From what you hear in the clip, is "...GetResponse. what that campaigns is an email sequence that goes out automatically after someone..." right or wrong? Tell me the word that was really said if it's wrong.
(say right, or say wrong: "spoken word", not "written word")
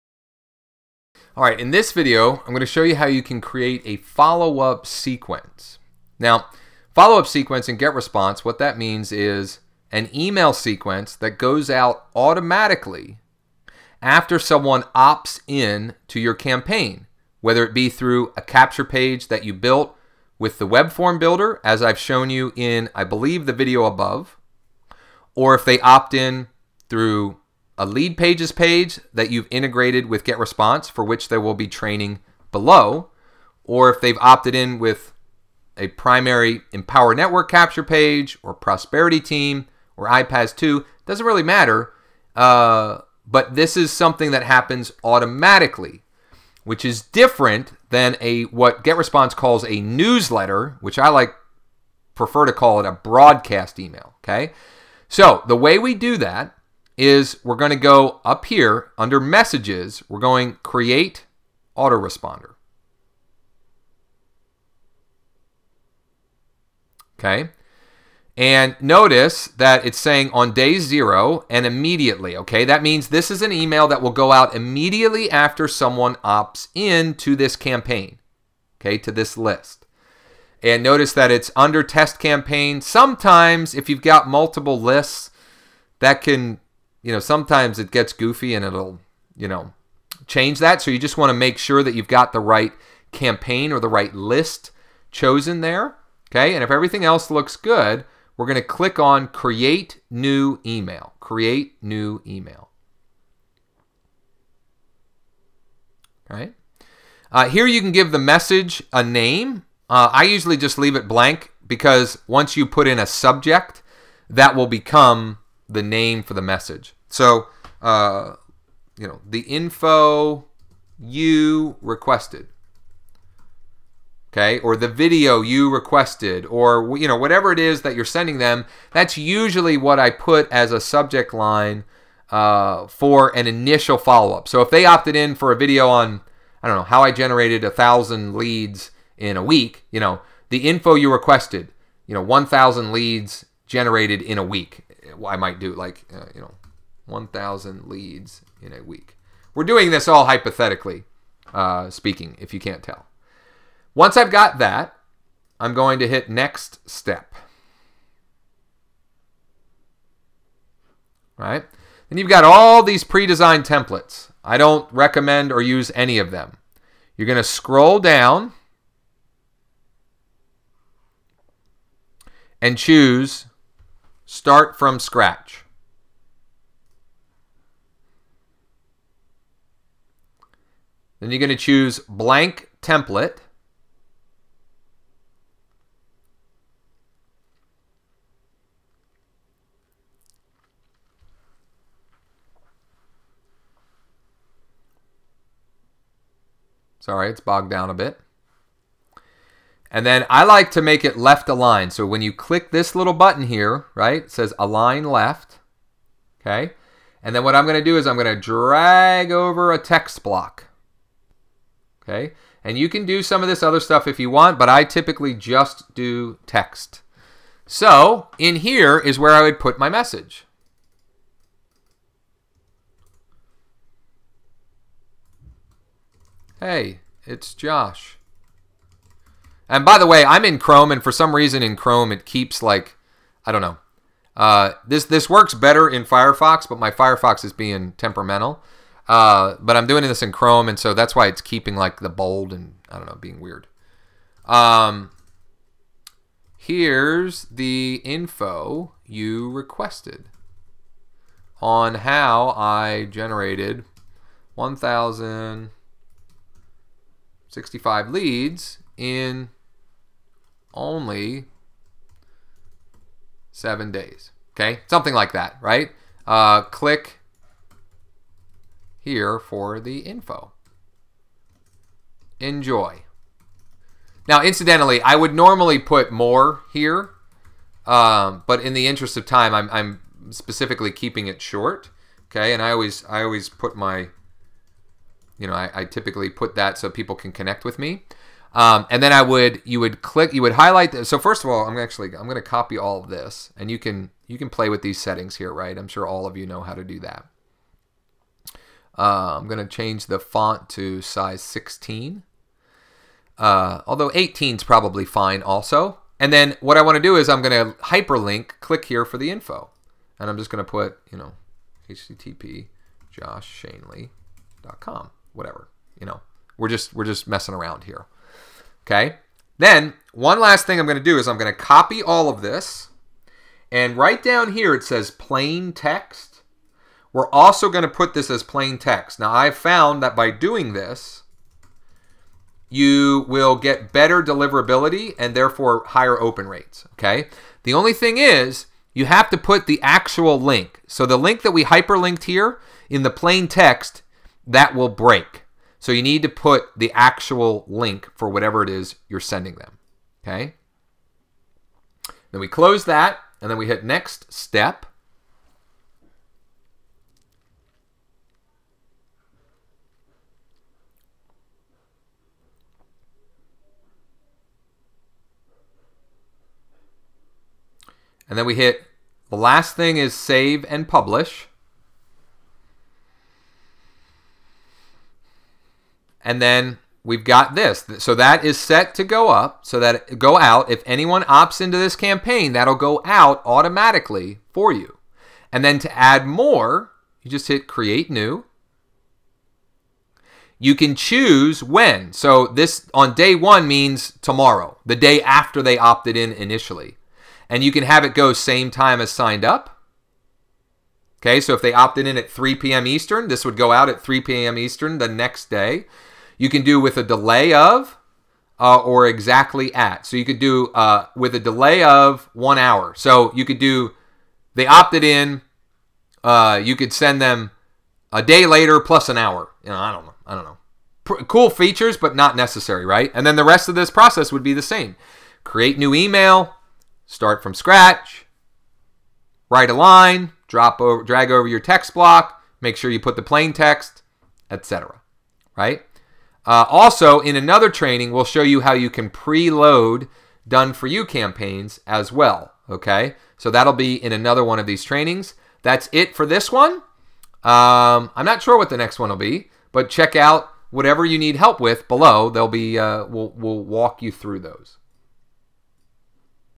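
wrong: "means", not "campaigns".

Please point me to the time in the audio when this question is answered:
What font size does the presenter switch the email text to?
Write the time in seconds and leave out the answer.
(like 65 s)
301 s.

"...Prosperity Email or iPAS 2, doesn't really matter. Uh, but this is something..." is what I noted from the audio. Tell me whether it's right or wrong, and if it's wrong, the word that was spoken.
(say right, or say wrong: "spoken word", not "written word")
wrong: "Team", not "Email".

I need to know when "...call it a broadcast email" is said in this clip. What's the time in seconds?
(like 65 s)
52 s.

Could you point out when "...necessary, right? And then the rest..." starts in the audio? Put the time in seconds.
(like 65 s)
422 s.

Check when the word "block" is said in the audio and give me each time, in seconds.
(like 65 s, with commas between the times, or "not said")
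210 s, 431 s.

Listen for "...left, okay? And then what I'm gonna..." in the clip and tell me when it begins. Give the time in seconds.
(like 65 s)
205 s.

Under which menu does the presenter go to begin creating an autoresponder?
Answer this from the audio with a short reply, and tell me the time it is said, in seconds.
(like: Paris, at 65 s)
messages, at 59 s.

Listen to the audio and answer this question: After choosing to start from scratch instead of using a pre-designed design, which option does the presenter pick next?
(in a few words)
blank template.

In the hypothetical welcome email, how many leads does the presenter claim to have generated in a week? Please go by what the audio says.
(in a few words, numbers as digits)
1,065.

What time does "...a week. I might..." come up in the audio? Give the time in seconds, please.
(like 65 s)
144 s.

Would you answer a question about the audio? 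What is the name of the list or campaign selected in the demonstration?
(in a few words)
test campaign.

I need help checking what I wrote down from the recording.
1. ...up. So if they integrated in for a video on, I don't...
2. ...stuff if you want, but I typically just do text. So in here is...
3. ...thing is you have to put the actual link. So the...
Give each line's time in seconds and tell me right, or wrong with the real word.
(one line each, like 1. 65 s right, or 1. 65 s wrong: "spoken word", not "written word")
1. 134 s wrong: "opted", not "integrated"
2. 213 s right
3. 337 s right.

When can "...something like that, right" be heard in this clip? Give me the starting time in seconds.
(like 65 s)
264 s.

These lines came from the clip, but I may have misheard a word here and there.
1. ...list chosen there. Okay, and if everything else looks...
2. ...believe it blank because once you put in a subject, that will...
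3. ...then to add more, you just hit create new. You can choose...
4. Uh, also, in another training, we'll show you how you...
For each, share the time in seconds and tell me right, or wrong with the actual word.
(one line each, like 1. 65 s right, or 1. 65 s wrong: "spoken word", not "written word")
1. 94 s right
2. 110 s wrong: "leave", not "believe"
3. 385 s right
4. 436 s right.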